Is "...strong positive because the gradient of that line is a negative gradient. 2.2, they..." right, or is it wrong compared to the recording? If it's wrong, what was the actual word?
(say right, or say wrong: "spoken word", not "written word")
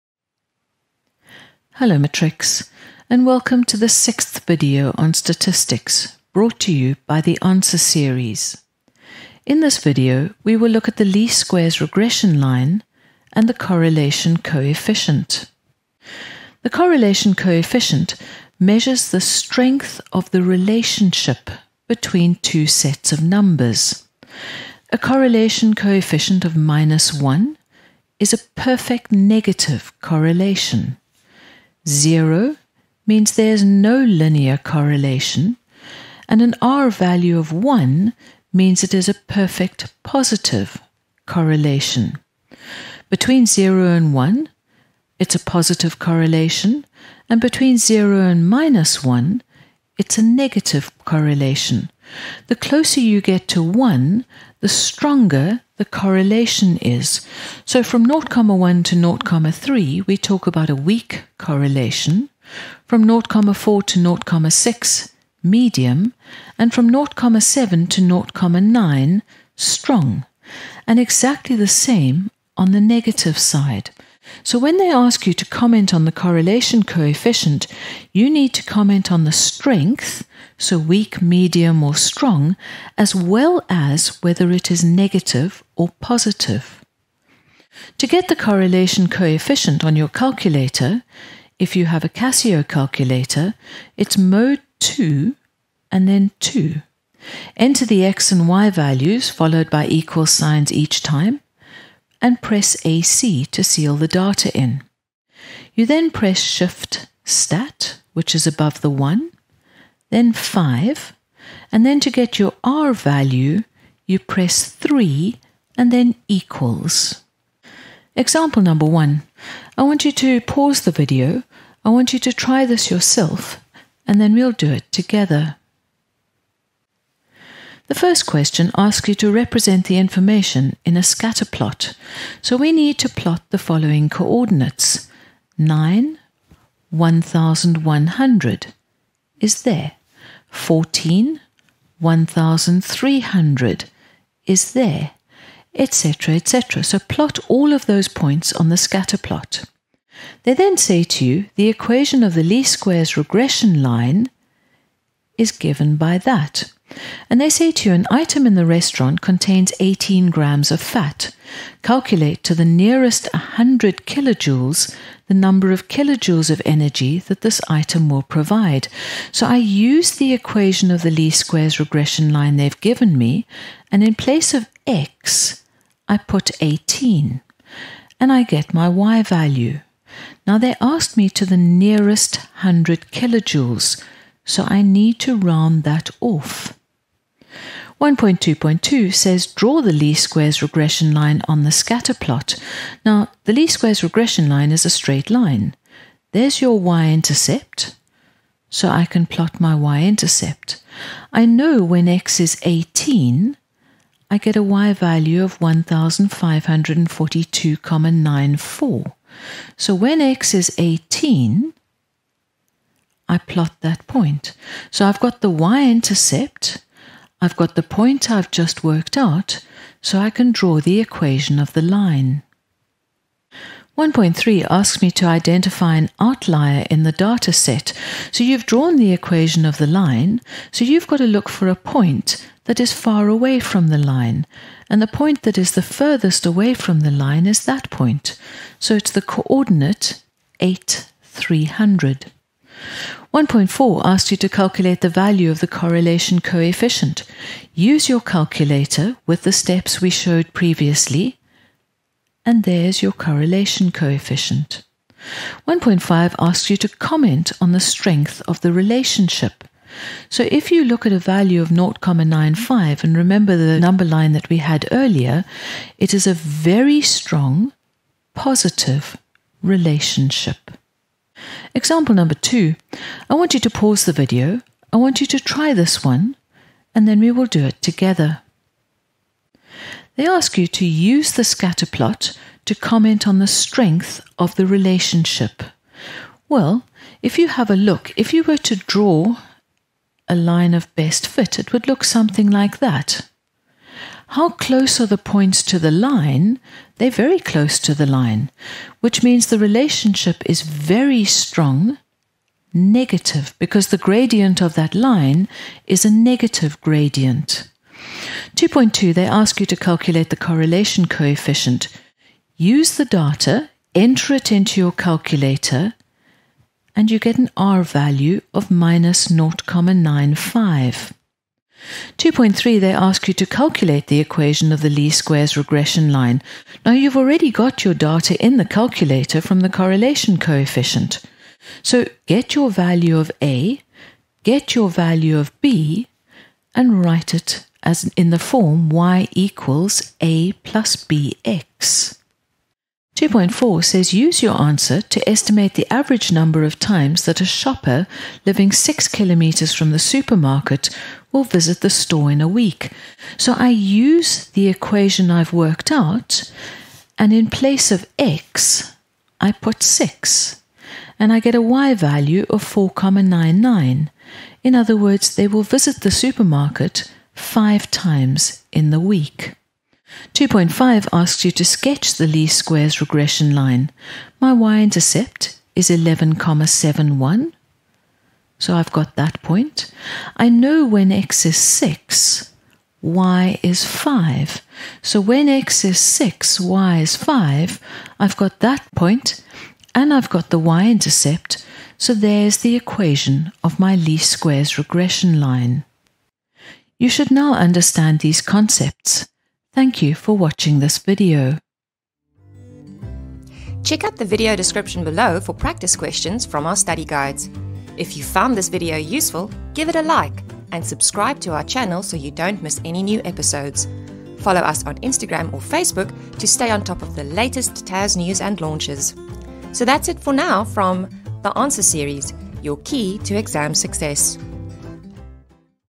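wrong: "negative", not "positive".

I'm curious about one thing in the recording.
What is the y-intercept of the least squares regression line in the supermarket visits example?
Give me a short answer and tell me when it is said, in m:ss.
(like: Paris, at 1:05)
11.71, at 6:15.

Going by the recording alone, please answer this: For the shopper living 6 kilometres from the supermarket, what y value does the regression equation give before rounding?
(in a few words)
4.99.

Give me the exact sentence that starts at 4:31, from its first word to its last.
Example number two, I want you to pause the video.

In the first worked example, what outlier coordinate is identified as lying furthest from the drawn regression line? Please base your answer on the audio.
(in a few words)
8, 300.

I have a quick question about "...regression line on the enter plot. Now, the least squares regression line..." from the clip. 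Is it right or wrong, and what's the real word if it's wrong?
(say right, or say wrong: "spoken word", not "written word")
wrong: "scatter", not "enter".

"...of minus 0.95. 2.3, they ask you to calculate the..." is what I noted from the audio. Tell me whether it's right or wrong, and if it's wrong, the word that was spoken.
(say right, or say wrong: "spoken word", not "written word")
right.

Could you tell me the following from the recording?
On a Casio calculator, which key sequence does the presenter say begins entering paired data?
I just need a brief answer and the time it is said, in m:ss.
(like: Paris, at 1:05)
mode 2 then 2, at 1:34.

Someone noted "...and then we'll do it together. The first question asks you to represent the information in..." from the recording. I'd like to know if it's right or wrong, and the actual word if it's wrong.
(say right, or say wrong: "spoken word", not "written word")
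right.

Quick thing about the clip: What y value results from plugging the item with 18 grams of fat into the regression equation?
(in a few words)
1542.94.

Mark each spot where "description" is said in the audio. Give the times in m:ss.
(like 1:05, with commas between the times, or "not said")
6:44.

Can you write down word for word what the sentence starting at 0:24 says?
A correlation coefficient of minus 1 is a perfect negative correlation.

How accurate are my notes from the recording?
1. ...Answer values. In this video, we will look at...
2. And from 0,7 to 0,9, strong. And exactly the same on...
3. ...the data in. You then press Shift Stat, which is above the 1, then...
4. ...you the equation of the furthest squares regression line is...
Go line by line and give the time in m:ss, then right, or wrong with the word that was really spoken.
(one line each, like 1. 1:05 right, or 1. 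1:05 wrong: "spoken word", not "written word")
1. 0:07 wrong: "series", not "values"
2. 1:06 right
3. 1:43 right
4. 2:31 wrong: "least", not "furthest".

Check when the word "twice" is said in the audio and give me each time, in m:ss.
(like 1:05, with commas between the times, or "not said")
not said.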